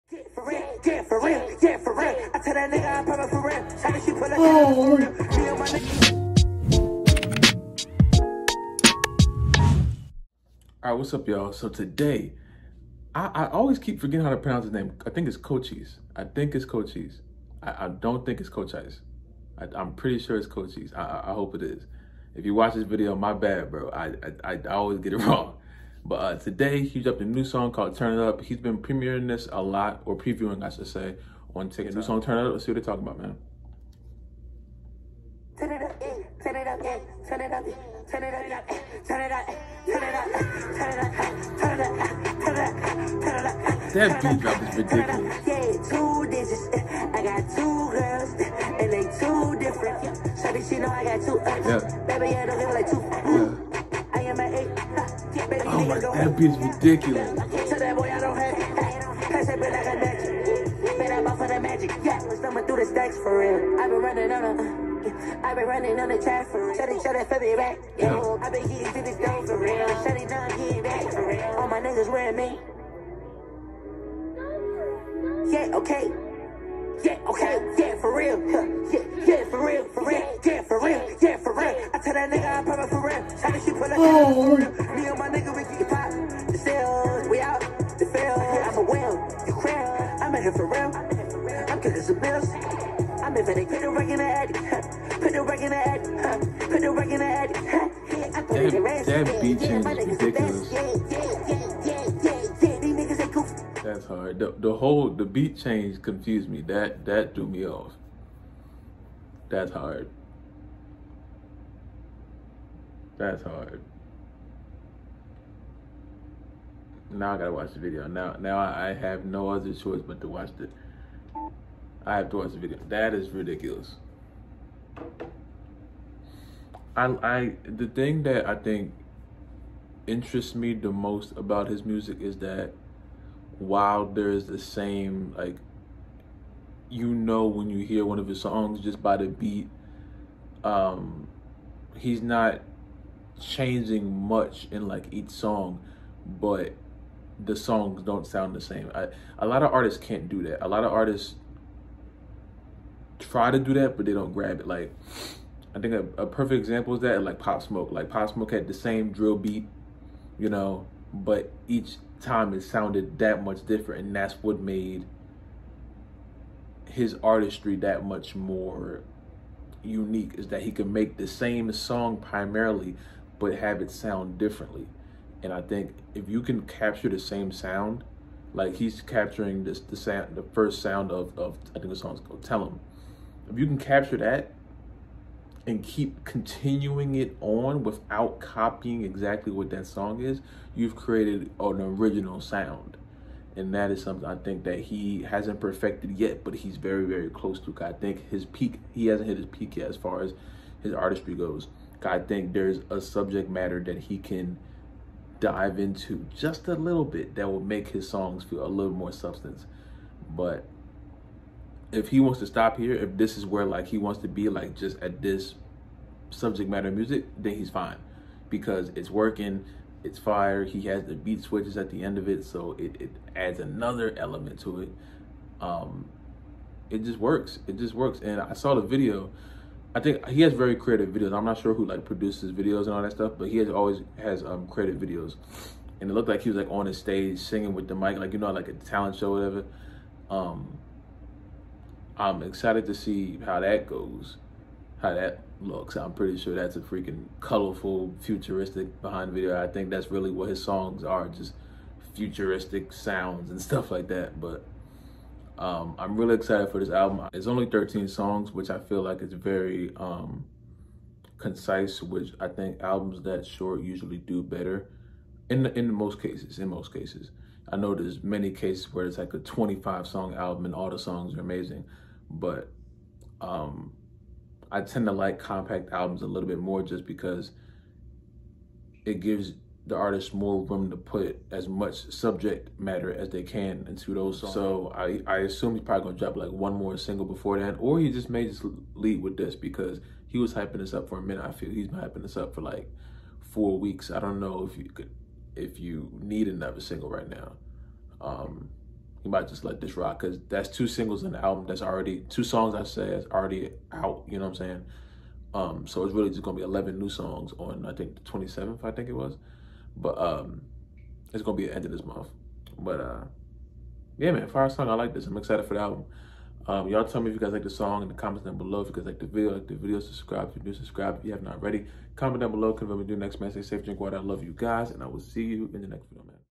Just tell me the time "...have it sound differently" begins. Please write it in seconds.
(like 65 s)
173 s.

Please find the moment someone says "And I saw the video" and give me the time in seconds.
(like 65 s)
228 s.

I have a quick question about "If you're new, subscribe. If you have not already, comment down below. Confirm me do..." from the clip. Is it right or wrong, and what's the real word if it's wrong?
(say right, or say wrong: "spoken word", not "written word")
right.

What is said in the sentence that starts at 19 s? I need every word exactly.
I, am pretty sure it's Cochise.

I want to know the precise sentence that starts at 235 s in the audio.
And it looked like he was like on his stage singing with the mic, like you know, like a talent show, whatever.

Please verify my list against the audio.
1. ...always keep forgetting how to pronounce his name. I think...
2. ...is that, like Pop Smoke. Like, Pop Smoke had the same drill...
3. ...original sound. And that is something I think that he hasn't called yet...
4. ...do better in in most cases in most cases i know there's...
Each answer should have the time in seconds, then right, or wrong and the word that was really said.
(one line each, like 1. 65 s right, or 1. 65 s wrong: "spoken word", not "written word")
1. 13 s right
2. 156 s right
3. 191 s wrong: "perfected", not "called"
4. 264 s right.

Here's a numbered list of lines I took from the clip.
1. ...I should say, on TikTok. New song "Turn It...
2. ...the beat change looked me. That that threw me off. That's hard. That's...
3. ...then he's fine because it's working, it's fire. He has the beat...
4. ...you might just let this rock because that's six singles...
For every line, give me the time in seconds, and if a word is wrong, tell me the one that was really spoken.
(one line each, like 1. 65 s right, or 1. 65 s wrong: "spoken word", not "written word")
1. 30 s right
2. 105 s wrong: "confused", not "looked"
3. 217 s right
4. 299 s wrong: "two", not "six".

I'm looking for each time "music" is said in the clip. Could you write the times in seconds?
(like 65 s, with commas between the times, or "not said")
131 s, 216 s.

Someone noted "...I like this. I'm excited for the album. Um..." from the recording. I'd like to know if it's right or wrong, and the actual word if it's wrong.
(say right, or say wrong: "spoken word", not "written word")
right.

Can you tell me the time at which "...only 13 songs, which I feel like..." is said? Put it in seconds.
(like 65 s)
257 s.